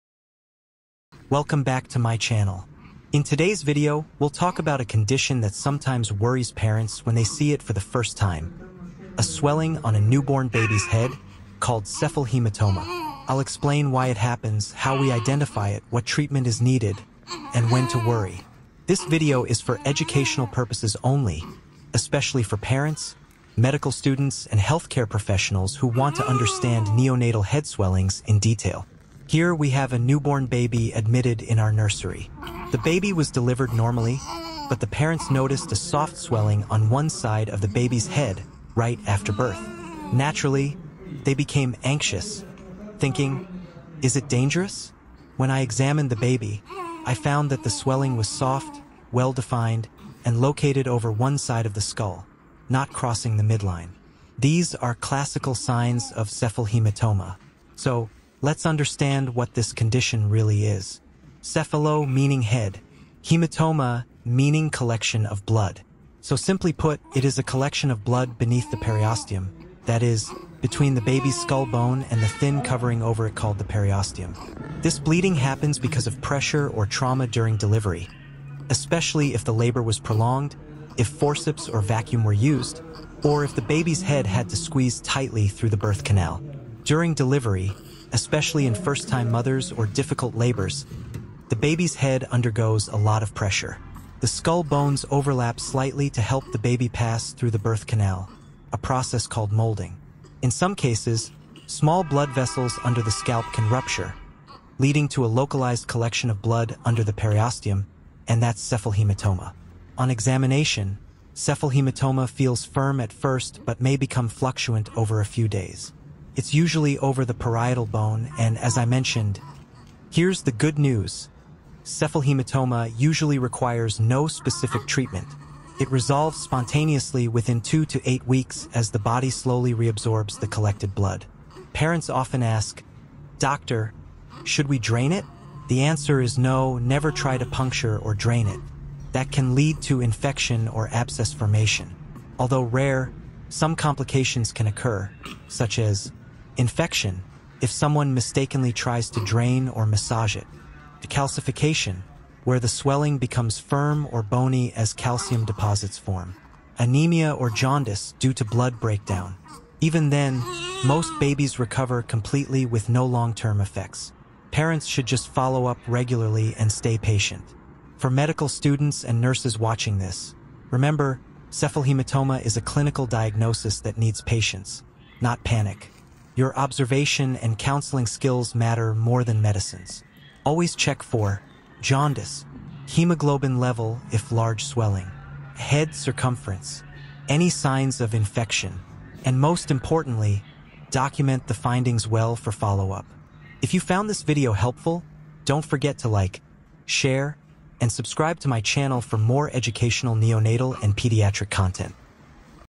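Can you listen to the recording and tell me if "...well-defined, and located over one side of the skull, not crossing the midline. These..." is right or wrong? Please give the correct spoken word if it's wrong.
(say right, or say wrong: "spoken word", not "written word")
right.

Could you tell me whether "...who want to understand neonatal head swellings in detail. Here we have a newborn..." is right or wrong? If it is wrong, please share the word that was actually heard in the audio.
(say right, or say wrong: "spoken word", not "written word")
right.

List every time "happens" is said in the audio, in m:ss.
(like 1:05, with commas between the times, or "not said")
0:14, 1:15.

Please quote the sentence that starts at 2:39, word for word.
Even then, most babies recover completely with no long-term effects.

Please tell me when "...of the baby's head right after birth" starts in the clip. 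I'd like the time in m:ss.
0:37.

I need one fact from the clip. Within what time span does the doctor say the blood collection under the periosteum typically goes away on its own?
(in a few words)
2 to 8 weeks.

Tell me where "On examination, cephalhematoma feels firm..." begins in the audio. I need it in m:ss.
1:49.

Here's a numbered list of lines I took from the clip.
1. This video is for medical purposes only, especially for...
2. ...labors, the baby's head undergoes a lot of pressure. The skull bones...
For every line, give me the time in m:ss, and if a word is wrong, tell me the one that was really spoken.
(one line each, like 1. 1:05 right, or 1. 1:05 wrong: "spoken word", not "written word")
1. 0:18 wrong: "educational", not "medical"
2. 1:30 right.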